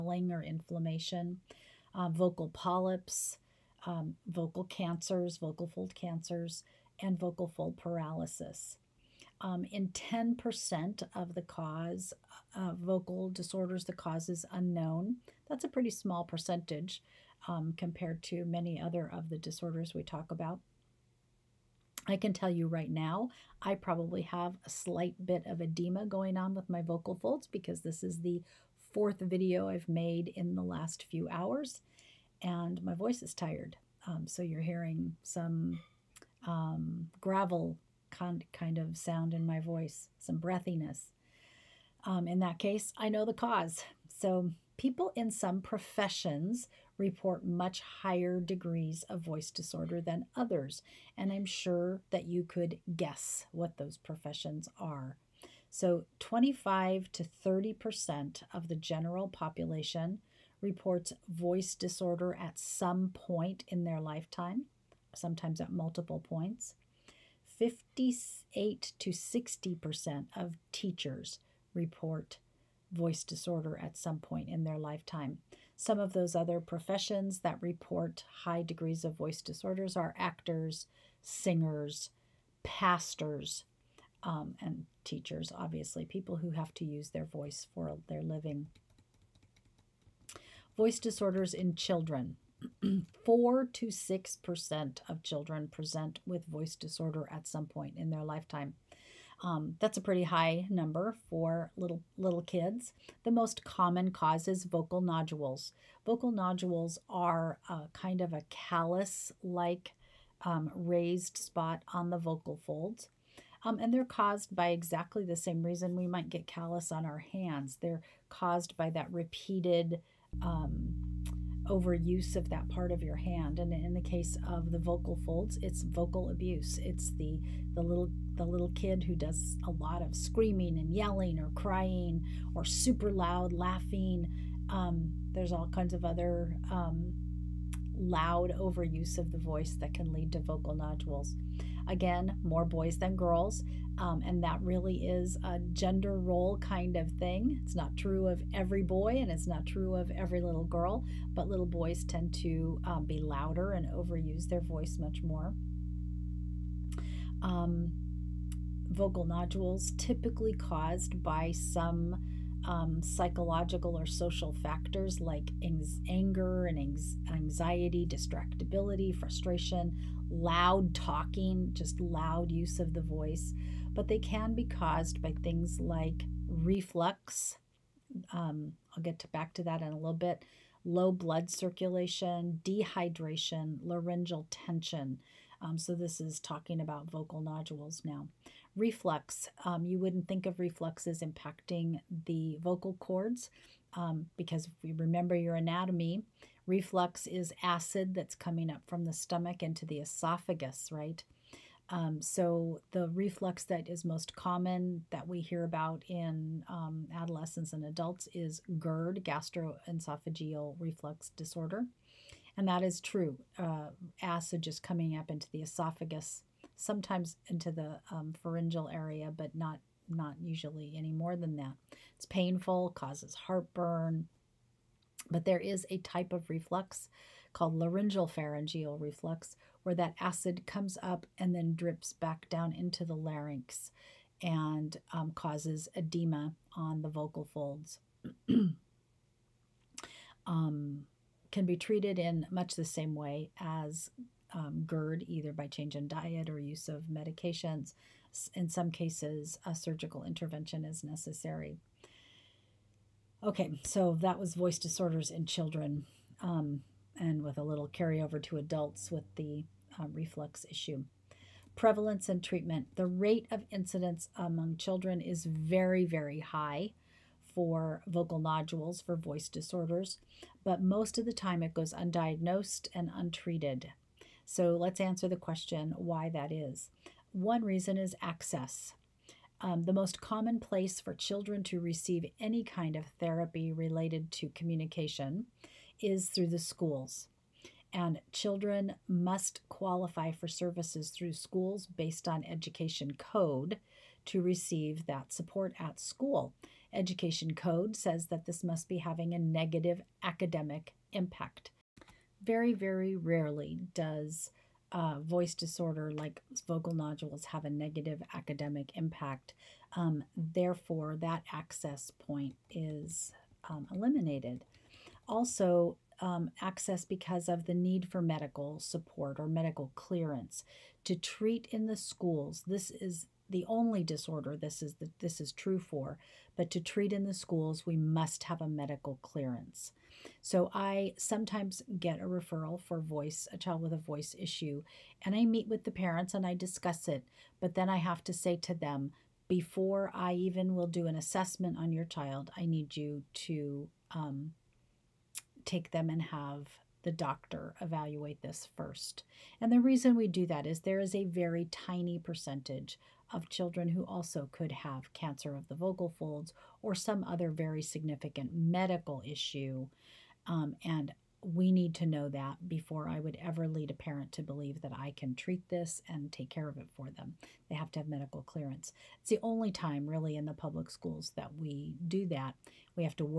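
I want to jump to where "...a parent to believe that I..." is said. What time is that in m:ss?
6:03.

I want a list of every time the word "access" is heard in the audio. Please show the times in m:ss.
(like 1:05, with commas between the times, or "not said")
4:38, 5:11, 5:16.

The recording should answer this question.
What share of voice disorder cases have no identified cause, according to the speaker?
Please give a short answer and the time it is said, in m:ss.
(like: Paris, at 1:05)
10%, at 0:09.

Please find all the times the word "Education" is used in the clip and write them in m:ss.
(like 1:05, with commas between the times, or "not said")
4:52, 4:56.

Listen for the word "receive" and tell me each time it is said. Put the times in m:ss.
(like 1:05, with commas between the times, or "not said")
4:41, 4:54.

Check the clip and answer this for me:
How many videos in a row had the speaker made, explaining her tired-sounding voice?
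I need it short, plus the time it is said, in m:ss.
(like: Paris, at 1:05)
fourth, at 0:28.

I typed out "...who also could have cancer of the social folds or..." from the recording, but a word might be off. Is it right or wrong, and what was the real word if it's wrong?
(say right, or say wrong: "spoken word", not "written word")
wrong: "vocal", not "social".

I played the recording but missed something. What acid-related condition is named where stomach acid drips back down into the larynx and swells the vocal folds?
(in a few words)
laryngeal pharyngeal reflux.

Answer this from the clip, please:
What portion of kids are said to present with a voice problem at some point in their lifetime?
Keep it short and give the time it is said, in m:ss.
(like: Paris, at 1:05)
4 to 6%, at 1:33.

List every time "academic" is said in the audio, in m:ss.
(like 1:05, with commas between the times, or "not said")
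5:00, 5:08.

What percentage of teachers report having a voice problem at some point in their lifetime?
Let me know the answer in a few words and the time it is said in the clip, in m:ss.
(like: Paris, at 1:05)
58 to 60%, at 1:07.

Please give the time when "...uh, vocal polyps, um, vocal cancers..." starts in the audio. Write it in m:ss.
0:01.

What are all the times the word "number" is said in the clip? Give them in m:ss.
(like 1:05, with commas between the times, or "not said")
1:40.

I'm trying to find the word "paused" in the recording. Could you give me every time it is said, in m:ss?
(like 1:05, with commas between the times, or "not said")
not said.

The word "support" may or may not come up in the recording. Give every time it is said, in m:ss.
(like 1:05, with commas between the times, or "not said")
4:55, 5:18.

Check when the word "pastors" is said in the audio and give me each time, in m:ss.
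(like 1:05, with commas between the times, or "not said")
1:22.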